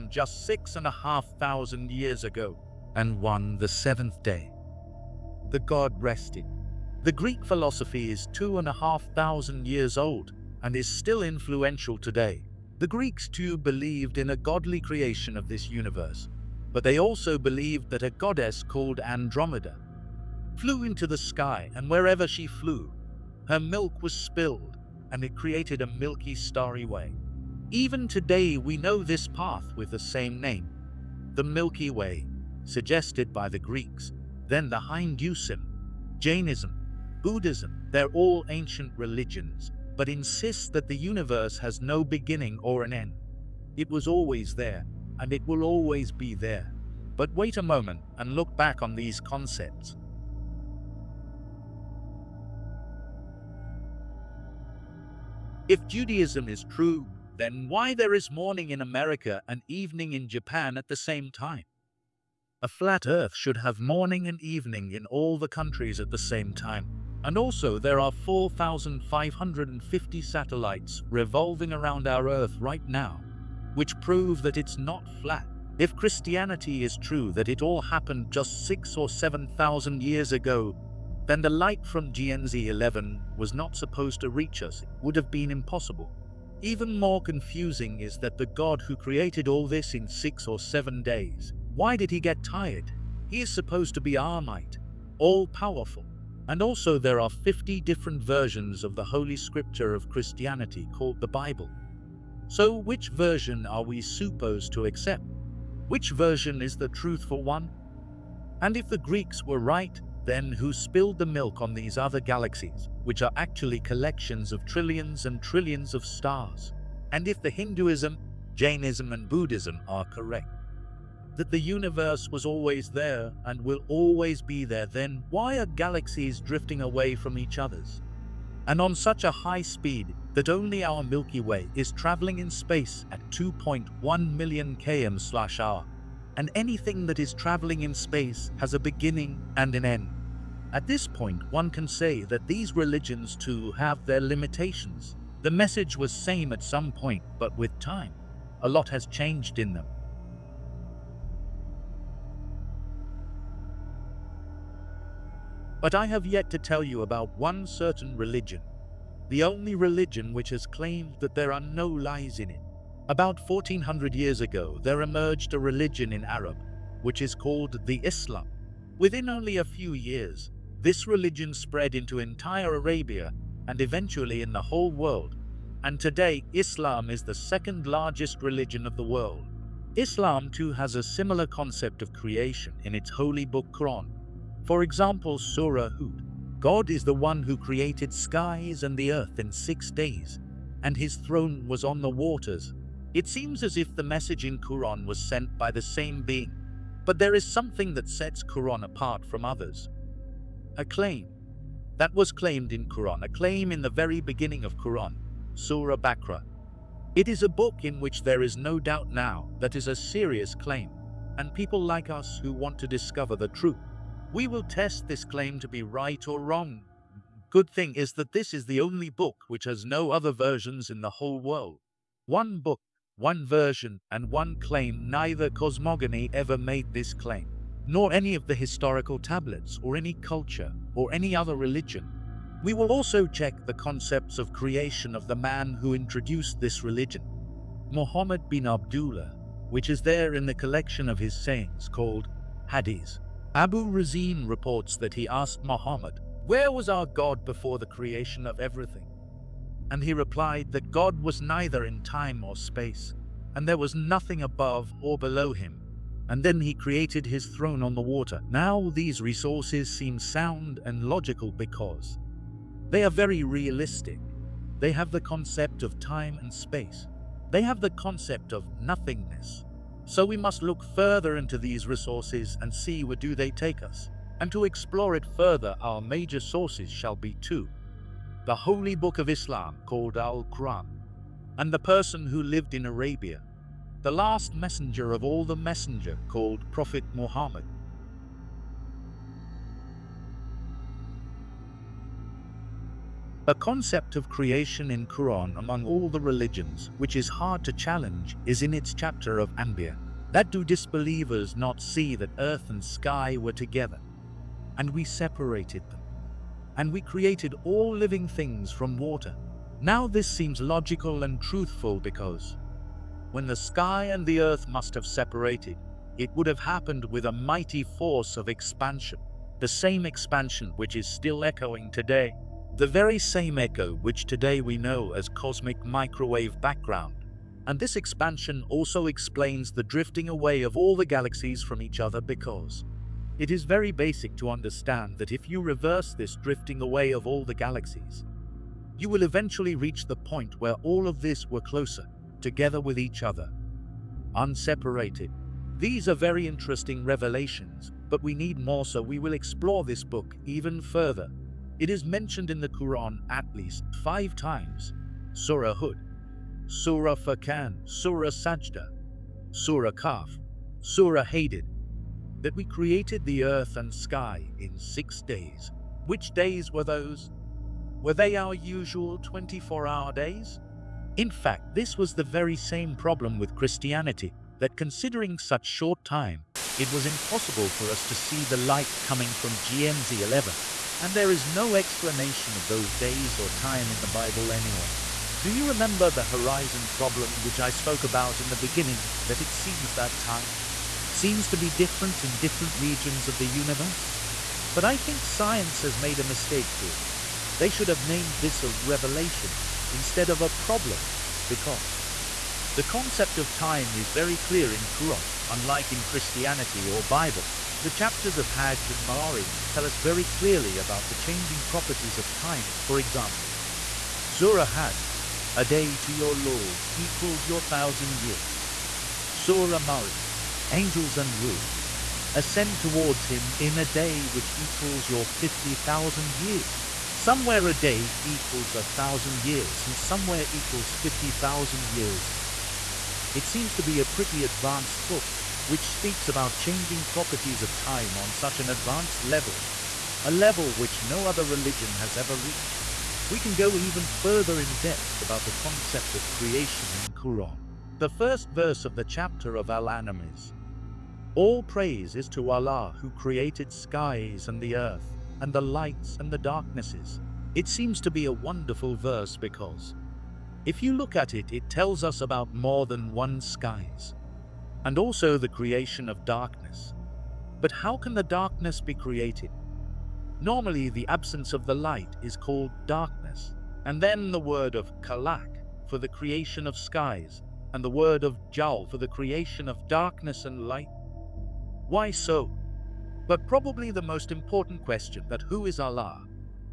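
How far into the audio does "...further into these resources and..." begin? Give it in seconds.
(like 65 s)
270 s.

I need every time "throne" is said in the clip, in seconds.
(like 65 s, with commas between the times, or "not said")
191 s, 257 s.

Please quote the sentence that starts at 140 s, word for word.
At this point, one can say that these religions too have their limitations.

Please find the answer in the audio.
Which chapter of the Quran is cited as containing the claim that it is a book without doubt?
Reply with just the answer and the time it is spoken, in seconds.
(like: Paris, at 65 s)
Surah Baqarah, at 205 s.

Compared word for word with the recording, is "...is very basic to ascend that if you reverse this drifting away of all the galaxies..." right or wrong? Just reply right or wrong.
wrong.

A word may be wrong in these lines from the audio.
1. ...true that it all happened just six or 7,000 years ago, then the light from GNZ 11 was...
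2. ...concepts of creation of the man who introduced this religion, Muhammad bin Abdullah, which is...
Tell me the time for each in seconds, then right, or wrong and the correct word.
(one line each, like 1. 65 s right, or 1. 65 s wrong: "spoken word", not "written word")
1. 76 s right
2. 233 s right.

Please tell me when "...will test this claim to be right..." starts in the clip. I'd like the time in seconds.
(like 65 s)
214 s.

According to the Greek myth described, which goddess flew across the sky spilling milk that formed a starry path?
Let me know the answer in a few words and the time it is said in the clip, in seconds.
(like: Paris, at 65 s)
Andromeda, at 18 s.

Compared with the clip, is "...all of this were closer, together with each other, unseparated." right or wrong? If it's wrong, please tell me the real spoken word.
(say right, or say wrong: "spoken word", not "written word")
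right.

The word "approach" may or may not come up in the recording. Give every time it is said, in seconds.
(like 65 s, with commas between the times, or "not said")
not said.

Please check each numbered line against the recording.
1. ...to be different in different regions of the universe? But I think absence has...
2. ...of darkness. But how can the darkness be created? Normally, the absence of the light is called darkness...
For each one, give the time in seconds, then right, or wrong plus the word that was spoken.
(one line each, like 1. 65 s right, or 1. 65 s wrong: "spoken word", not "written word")
1. 391 s wrong: "science", not "absence"
2. 466 s right.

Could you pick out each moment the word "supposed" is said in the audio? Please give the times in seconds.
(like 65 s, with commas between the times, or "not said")
83 s, 93 s, 104 s.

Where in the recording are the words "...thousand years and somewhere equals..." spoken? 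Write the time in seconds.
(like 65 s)
428 s.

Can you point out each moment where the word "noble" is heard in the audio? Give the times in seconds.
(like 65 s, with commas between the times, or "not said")
not said.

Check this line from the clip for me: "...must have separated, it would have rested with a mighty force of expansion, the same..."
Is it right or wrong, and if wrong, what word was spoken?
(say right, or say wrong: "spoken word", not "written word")
wrong: "happened", not "rested".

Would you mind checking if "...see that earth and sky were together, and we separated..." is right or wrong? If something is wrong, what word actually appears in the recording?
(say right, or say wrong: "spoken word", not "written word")
right.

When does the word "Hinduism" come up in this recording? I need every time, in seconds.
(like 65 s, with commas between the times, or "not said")
34 s, 117 s.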